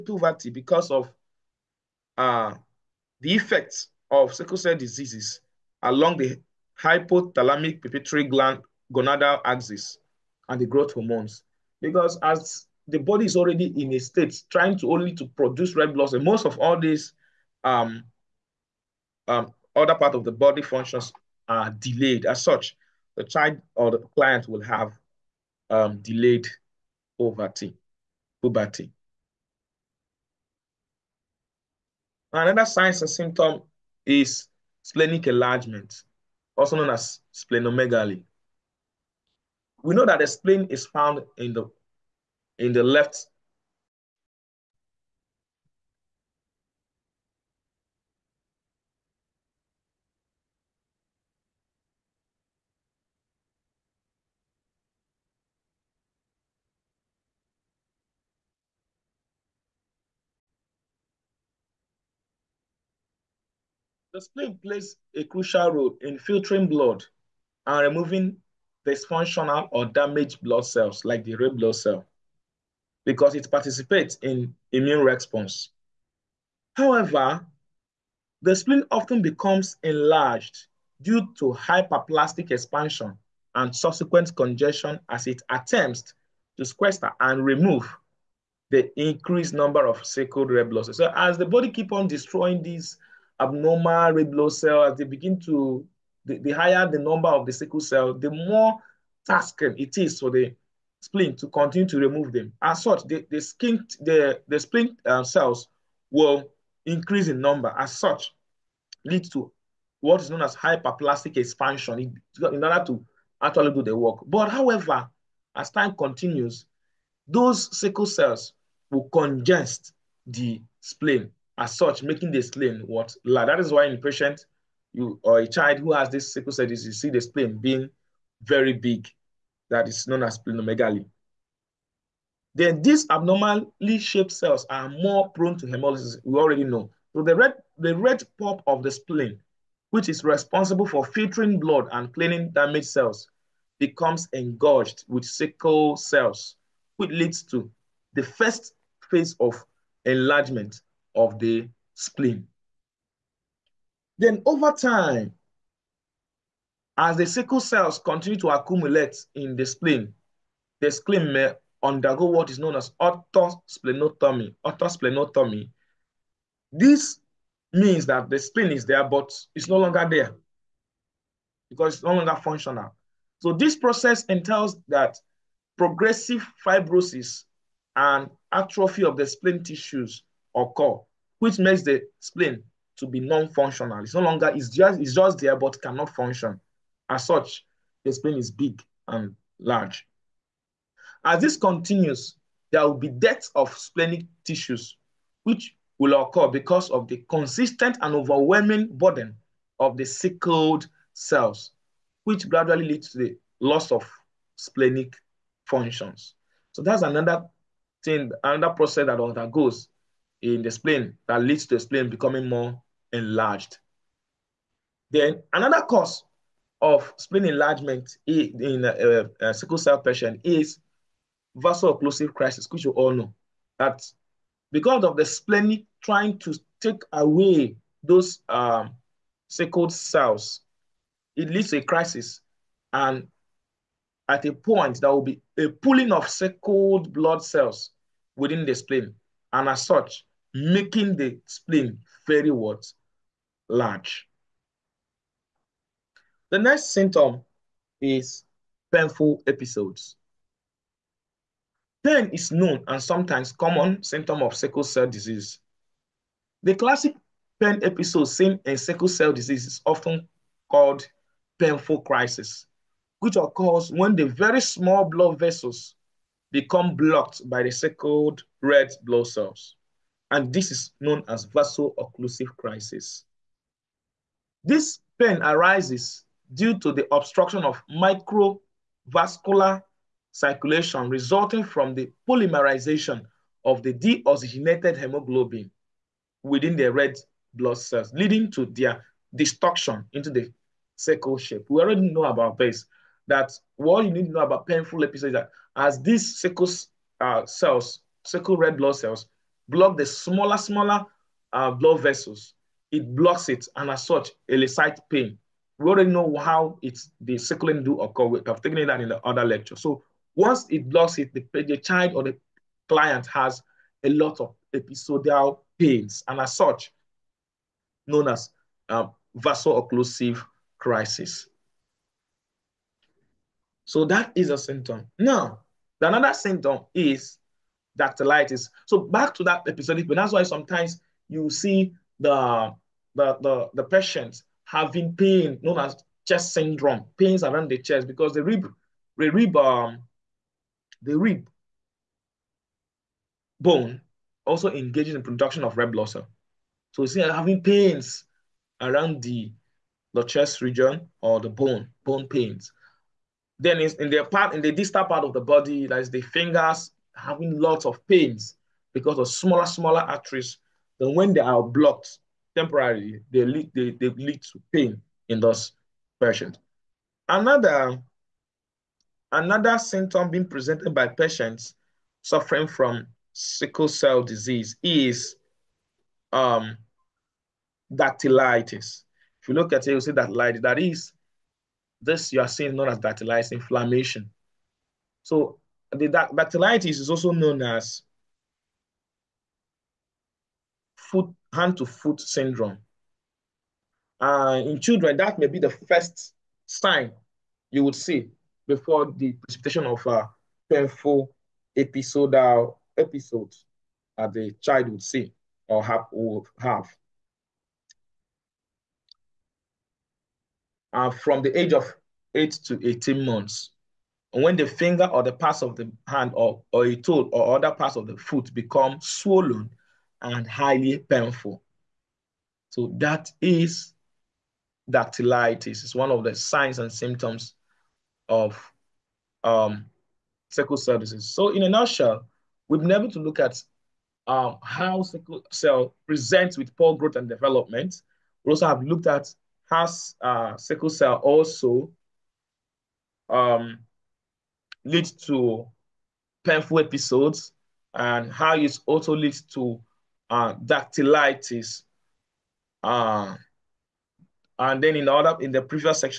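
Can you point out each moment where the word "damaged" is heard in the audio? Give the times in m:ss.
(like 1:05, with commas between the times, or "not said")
1:09, 2:22.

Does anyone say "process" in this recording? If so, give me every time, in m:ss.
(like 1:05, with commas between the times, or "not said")
2:53, 3:28.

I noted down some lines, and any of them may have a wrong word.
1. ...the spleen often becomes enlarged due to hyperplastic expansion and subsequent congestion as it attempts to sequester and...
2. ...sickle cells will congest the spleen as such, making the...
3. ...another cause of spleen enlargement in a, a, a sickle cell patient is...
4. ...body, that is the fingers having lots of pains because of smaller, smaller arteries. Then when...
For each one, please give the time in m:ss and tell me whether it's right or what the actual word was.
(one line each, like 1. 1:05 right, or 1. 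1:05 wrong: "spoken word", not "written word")
1. 1:18 right
2. 1:57 right
3. 3:35 right
4. 5:55 right.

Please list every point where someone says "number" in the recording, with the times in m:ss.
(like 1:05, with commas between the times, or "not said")
1:29, 1:36, 1:47.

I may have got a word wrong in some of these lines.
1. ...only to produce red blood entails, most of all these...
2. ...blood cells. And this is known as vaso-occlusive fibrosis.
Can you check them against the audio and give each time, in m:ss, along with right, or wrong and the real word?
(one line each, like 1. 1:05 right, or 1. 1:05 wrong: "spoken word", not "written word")
1. 0:14 wrong: "cells", not "entails"
2. 4:29 wrong: "crisis", not "fibrosis".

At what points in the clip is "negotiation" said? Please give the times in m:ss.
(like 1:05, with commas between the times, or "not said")
not said.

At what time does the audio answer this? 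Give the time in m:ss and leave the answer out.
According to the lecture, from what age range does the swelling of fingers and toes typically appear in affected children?
6:52.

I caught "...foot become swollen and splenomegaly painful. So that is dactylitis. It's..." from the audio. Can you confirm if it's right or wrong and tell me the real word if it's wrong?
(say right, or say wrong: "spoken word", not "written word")
wrong: "highly", not "splenomegaly".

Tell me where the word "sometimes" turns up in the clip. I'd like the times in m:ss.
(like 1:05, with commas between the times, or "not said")
4:13, 5:30.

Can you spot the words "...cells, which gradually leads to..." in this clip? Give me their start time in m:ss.
3:21.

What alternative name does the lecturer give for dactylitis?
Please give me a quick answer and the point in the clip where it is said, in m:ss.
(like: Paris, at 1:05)
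hand to foot syndrome, at 6:31.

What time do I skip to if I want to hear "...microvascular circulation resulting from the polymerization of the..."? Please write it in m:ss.
4:37.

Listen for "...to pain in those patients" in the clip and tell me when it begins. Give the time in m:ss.
6:04.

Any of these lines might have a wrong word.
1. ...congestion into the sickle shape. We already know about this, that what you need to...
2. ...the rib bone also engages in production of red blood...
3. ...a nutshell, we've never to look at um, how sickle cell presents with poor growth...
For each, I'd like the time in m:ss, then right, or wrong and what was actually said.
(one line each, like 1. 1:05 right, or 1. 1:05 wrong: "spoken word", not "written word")
1. 4:49 wrong: "destruction", not "congestion"
2. 5:41 right
3. 7:11 right.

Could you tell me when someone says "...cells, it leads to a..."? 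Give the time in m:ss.
3:49.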